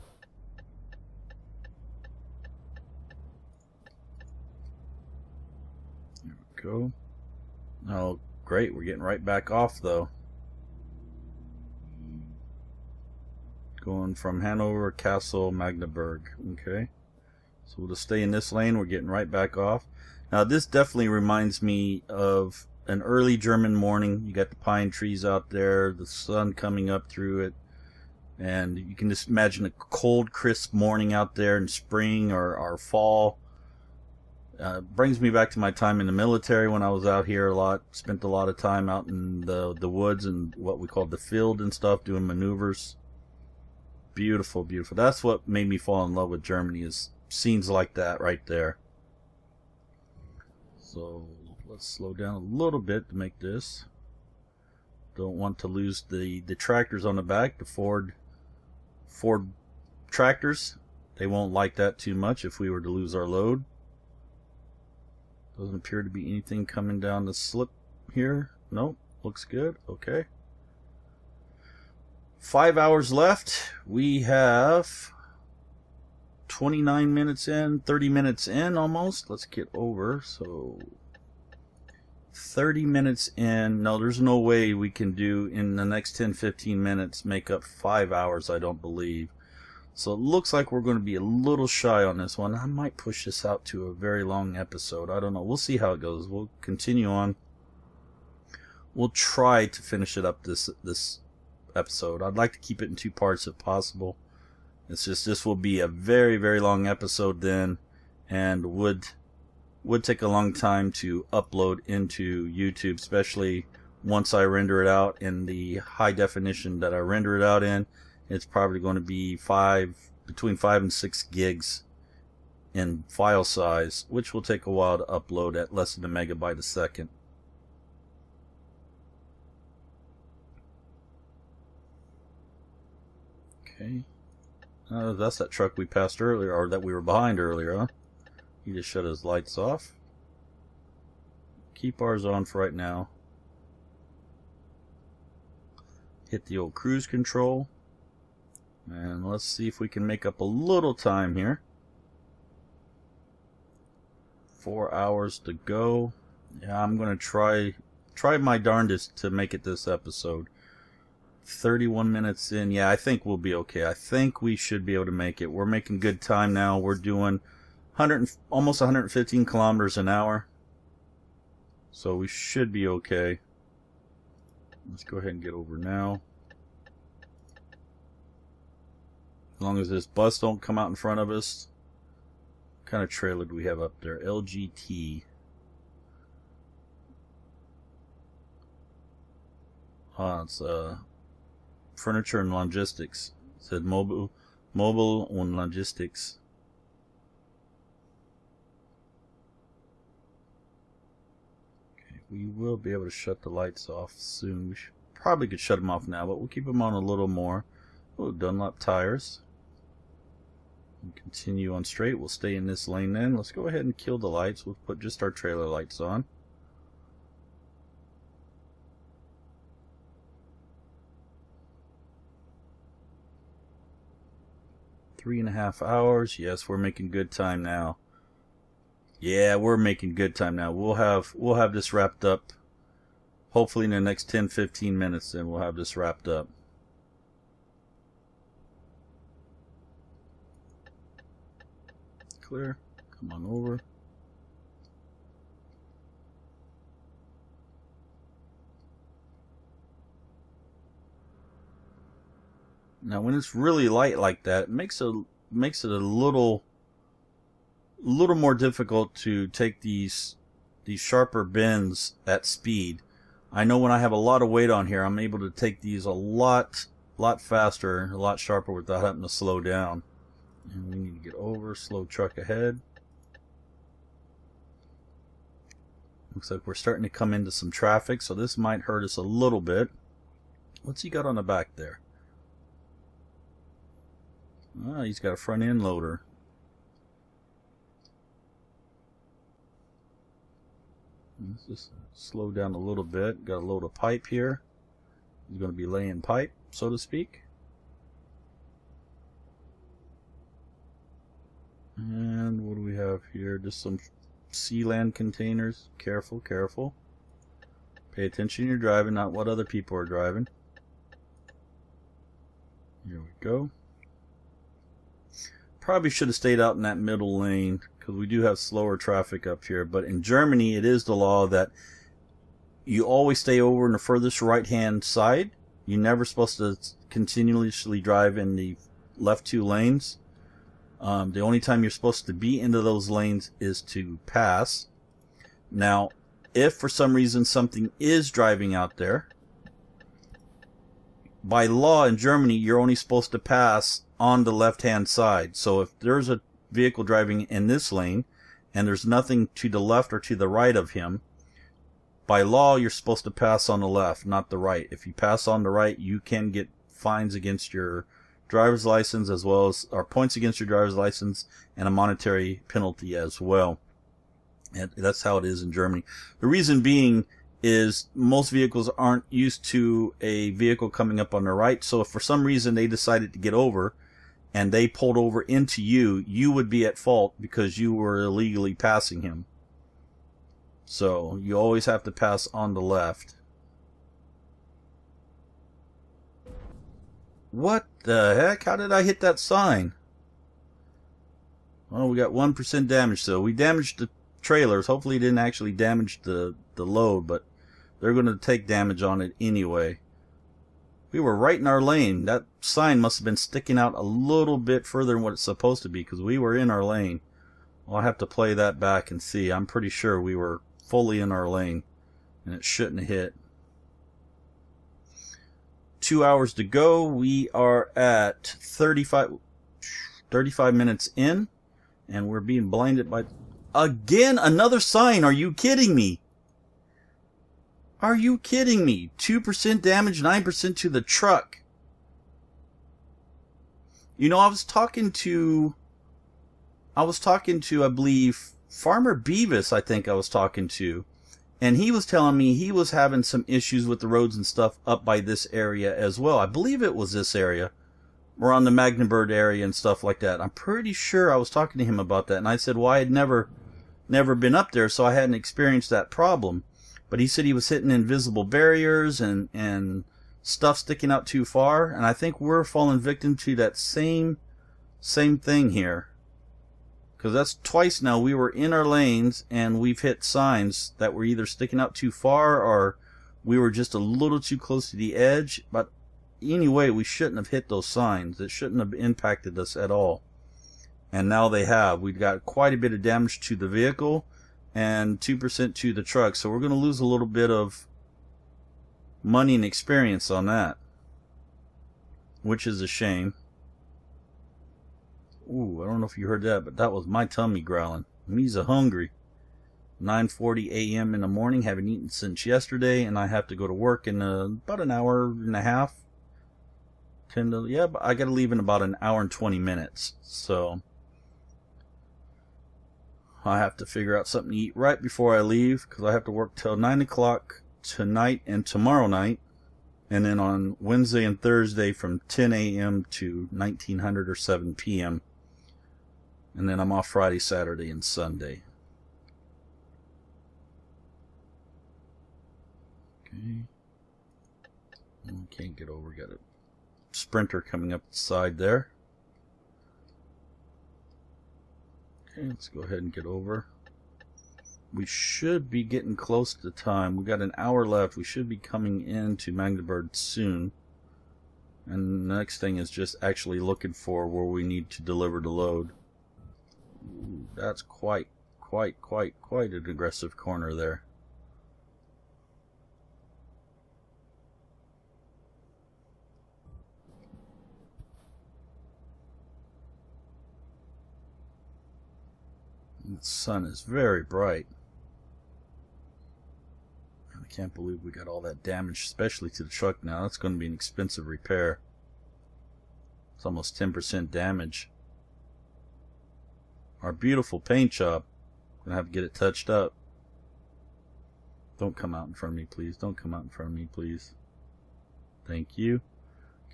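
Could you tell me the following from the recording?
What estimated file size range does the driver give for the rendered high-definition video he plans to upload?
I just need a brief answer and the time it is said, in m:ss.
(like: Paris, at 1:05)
5 to 6 gigs, at 2:00.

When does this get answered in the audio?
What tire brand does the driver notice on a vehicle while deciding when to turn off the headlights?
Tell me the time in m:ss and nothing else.
3:28.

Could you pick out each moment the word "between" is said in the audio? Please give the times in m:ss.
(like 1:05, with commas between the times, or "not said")
2:00.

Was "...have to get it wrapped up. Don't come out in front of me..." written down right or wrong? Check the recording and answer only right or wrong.
wrong.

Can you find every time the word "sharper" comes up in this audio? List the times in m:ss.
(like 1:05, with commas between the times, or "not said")
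4:20, 4:28.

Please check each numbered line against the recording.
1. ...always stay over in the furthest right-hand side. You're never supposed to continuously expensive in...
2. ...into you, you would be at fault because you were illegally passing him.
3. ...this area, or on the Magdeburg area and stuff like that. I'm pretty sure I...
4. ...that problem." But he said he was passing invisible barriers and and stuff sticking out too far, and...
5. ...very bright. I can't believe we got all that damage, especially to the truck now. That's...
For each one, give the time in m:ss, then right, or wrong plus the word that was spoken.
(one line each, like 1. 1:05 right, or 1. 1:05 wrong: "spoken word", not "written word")
1. 5:23 wrong: "drive", not "expensive"
2. 6:15 right
3. 7:27 right
4. 7:35 wrong: "hitting", not "passing"
5. 9:33 right.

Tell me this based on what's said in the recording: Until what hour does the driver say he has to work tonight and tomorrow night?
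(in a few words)
9 o'clock.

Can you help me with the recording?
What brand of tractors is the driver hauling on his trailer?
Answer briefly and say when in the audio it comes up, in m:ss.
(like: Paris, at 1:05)
Ford, at 0:57.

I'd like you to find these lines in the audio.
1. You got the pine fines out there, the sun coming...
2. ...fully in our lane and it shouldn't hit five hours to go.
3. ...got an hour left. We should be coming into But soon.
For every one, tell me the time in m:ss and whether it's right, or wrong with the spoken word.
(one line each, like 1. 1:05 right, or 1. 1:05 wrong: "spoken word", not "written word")
1. 0:24 wrong: "trees", not "fines"
2. 6:50 wrong: "two", not "five"
3. 9:07 wrong: "Magdeburg", not "But".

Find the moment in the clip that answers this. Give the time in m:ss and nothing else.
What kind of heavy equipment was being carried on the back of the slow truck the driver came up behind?
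4:45.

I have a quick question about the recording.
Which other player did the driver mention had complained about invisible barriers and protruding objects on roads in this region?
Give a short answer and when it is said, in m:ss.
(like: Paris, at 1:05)
Farmer Beavis, at 7:18.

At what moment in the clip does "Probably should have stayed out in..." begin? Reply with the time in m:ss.
5:15.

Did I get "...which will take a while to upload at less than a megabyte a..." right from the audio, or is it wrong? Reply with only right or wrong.
right.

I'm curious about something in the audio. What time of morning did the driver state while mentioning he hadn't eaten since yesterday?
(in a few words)
9:40 a.m.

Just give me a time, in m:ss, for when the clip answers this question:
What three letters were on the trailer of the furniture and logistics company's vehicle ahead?
3:04.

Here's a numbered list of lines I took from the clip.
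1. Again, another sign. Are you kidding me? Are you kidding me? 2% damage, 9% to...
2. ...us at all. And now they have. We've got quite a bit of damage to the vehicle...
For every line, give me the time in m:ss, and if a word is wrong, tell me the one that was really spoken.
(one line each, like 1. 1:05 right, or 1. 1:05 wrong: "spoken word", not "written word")
1. 7:03 right
2. 7:59 right.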